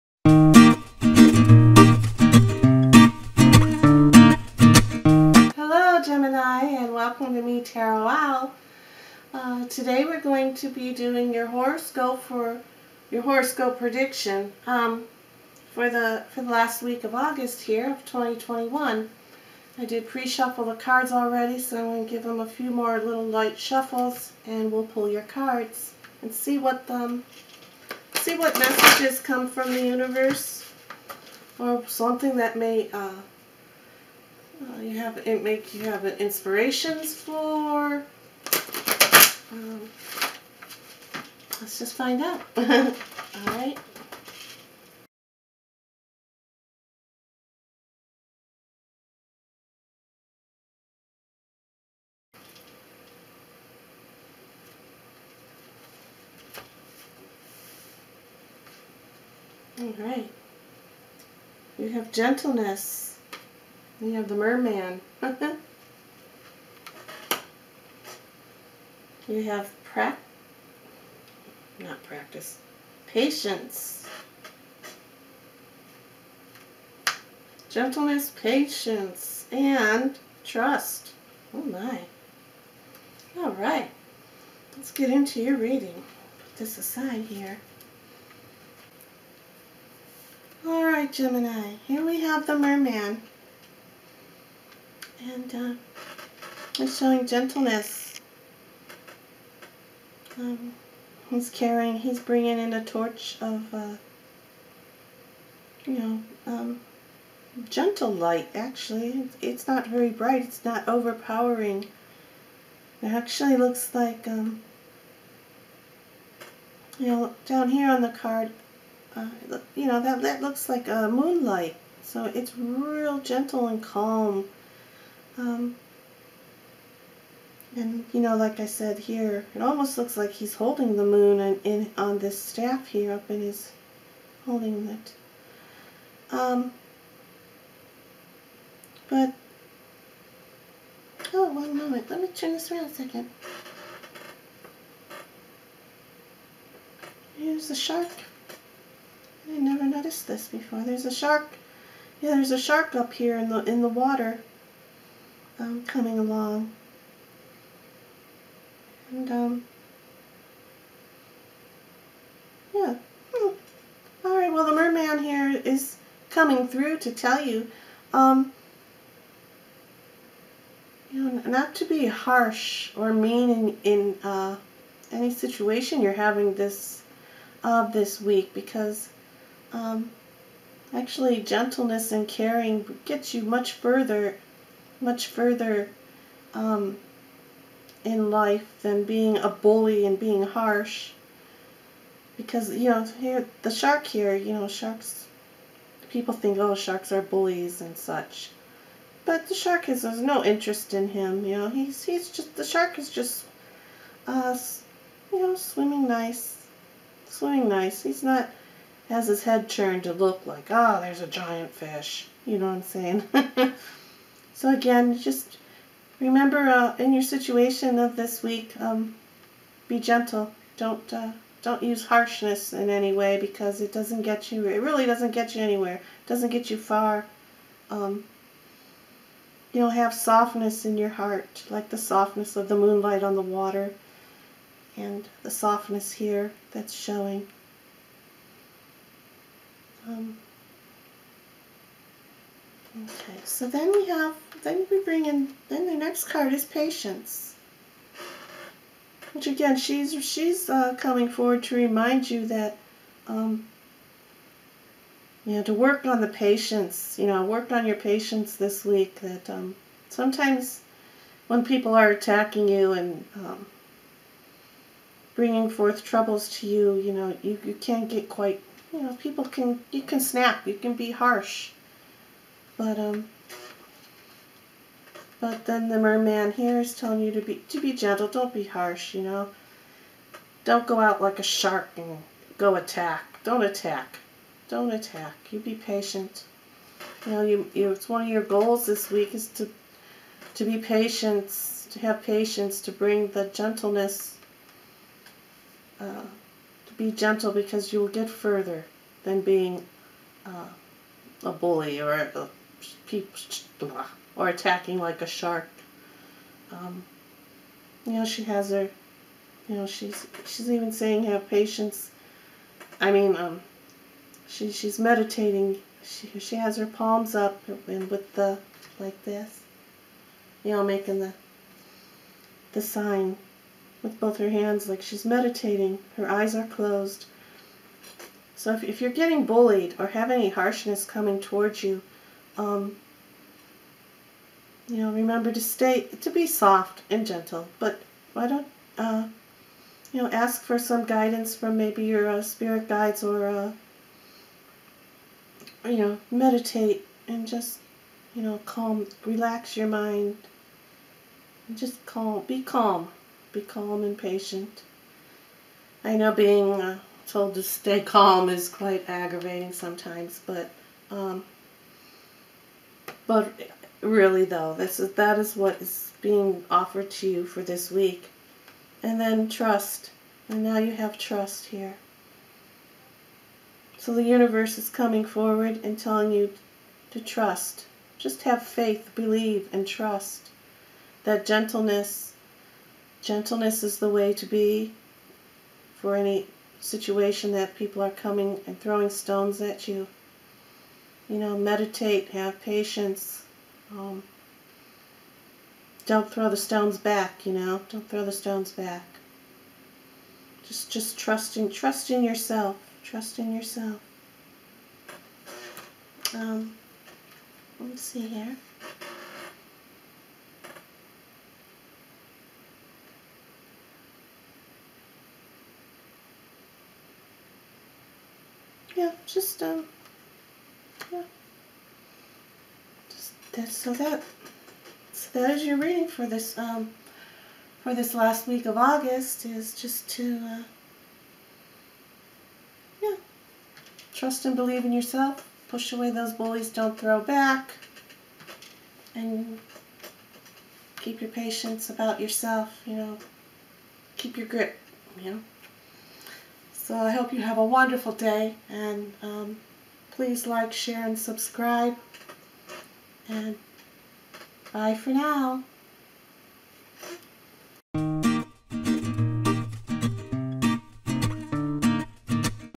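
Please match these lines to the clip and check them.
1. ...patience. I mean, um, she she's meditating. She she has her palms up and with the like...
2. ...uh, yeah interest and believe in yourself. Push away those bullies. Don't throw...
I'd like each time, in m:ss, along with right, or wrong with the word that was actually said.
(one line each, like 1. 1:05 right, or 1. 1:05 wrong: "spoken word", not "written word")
1. 5:11 right
2. 7:10 wrong: "trust", not "interest".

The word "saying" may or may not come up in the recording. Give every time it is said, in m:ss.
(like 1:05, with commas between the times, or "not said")
3:33, 5:10.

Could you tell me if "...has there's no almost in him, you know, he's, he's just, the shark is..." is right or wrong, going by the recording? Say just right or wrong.
wrong.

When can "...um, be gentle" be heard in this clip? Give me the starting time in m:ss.
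3:38.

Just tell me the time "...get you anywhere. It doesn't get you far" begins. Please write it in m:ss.
3:45.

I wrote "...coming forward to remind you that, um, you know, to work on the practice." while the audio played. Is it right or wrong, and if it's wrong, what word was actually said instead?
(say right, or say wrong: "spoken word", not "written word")
wrong: "patience", not "practice".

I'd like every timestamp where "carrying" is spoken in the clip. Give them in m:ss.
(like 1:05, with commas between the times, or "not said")
1:41.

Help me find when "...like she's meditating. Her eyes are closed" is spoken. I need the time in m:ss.
5:24.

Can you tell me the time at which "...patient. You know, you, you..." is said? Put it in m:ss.
4:45.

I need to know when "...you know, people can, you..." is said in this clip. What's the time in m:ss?
4:28.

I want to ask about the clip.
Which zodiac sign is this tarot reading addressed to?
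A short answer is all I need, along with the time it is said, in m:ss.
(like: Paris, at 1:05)
Gemini, at 1:31.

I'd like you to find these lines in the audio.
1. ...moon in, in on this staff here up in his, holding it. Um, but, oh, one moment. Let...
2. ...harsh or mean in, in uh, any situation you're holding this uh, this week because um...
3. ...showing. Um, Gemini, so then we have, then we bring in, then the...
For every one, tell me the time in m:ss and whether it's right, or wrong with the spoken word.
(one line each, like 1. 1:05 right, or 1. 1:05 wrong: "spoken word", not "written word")
1. 2:11 right
2. 2:52 wrong: "having", not "holding"
3. 3:56 wrong: "Okay", not "Gemini".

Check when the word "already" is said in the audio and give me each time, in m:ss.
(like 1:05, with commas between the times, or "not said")
0:21.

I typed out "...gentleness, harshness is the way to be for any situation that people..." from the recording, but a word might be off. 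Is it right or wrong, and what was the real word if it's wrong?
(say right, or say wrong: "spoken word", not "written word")
wrong: "gentleness", not "harshness".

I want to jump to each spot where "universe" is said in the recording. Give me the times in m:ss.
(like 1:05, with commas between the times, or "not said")
0:29, 6:14.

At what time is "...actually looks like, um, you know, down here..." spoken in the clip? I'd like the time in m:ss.
1:53.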